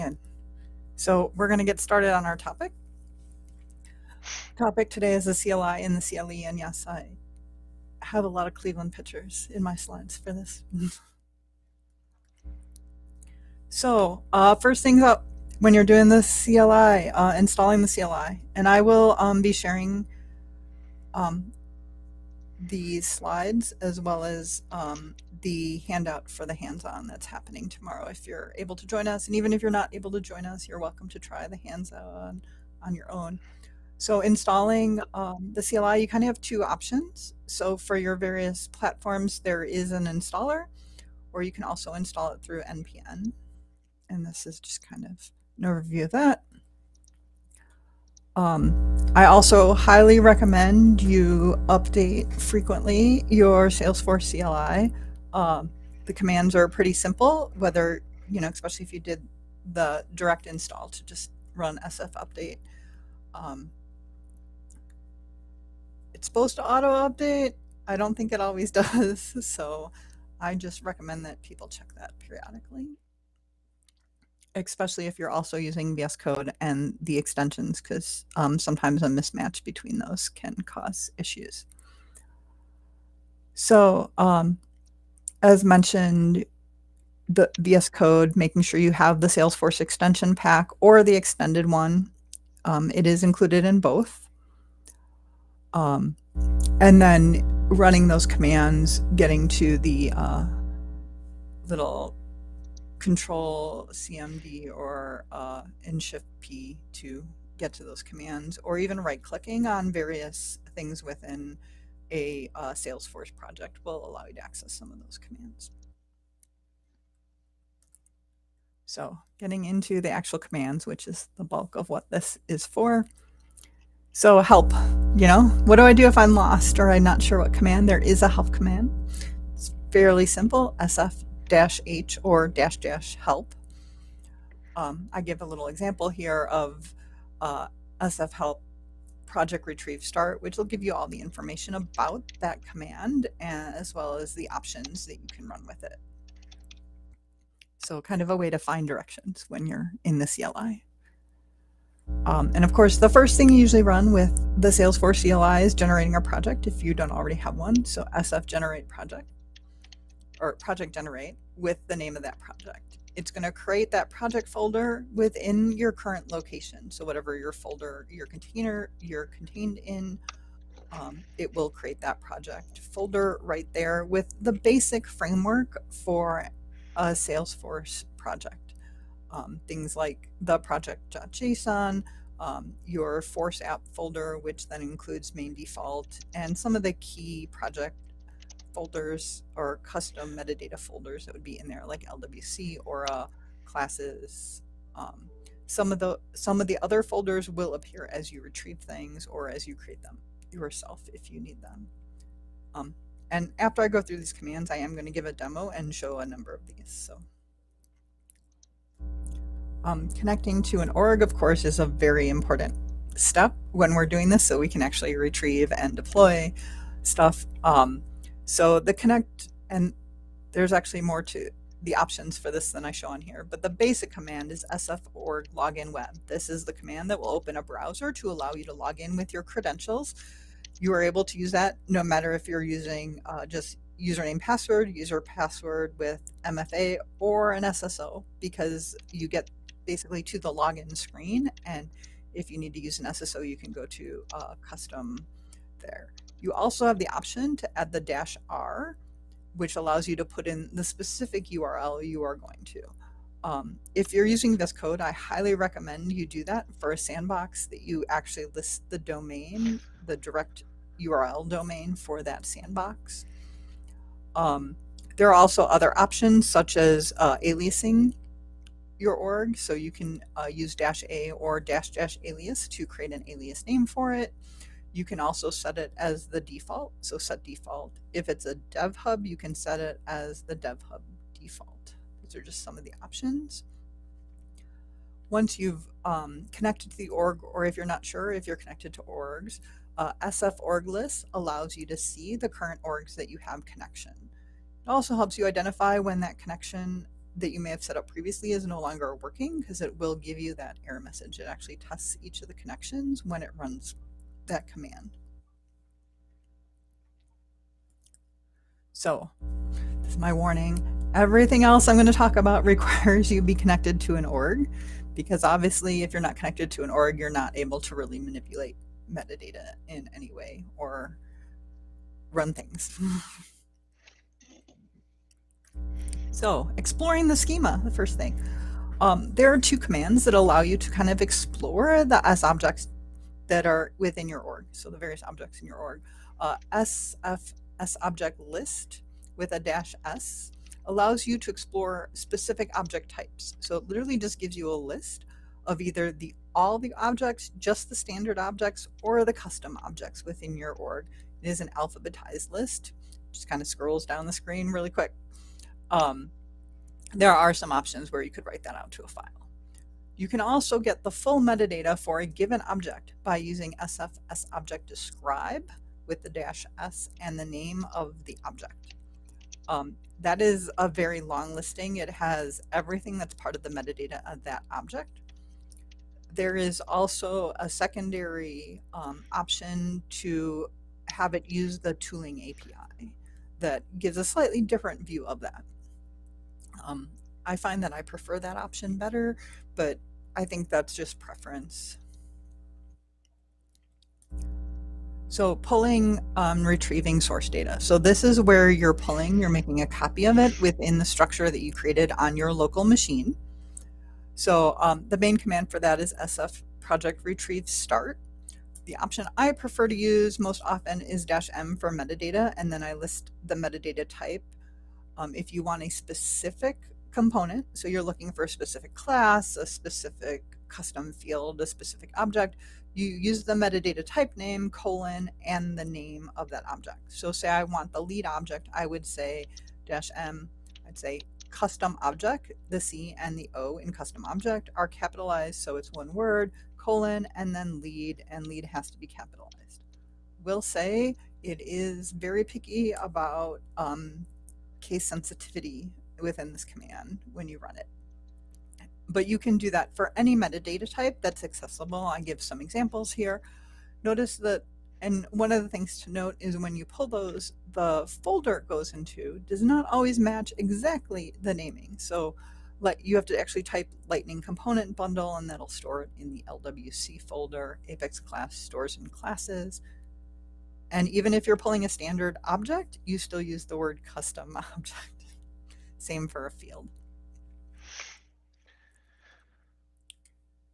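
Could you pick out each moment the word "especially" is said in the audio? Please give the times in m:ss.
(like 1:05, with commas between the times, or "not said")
0:58, 1:14.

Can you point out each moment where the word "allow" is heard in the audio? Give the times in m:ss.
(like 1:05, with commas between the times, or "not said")
1:54, 3:48, 4:09, 4:51, 5:30, 5:40.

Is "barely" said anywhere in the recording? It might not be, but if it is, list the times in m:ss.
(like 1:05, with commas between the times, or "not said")
not said.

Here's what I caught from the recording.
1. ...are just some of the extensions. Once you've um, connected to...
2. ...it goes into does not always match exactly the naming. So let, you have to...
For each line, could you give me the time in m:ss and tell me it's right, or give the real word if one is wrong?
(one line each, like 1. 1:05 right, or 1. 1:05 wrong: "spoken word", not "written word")
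1. 4:42 wrong: "options", not "extensions"
2. 7:38 right.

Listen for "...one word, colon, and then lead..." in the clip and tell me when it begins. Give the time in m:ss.
7:15.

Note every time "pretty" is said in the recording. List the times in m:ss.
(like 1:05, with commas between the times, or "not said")
0:56.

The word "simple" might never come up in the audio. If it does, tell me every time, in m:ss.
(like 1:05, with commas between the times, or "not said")
0:56, 2:10.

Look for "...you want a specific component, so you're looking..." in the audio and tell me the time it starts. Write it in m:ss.
6:55.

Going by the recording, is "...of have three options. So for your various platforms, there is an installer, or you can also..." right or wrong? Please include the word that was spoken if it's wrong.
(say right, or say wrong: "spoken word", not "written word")
wrong: "two", not "three".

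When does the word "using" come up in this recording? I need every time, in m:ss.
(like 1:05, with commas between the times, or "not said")
1:15, 3:52, 4:14, 6:03.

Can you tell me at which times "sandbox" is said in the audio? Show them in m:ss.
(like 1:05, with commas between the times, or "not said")
4:16, 4:22.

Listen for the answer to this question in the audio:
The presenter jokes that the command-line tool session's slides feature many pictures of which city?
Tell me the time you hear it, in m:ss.
0:08.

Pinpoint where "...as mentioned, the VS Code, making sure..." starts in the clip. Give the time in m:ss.
1:25.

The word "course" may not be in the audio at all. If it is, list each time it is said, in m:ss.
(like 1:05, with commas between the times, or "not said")
2:32, 3:31.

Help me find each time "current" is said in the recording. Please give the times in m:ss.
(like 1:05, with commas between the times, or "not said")
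2:45, 4:52.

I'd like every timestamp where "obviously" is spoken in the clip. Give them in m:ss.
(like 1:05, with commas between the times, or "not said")
5:15.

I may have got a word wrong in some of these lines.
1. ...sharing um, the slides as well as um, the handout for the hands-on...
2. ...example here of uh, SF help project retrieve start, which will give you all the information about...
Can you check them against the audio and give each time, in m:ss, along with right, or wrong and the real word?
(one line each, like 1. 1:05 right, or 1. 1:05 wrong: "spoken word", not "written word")
1. 0:19 right
2. 2:15 right.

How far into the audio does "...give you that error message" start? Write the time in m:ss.
5:00.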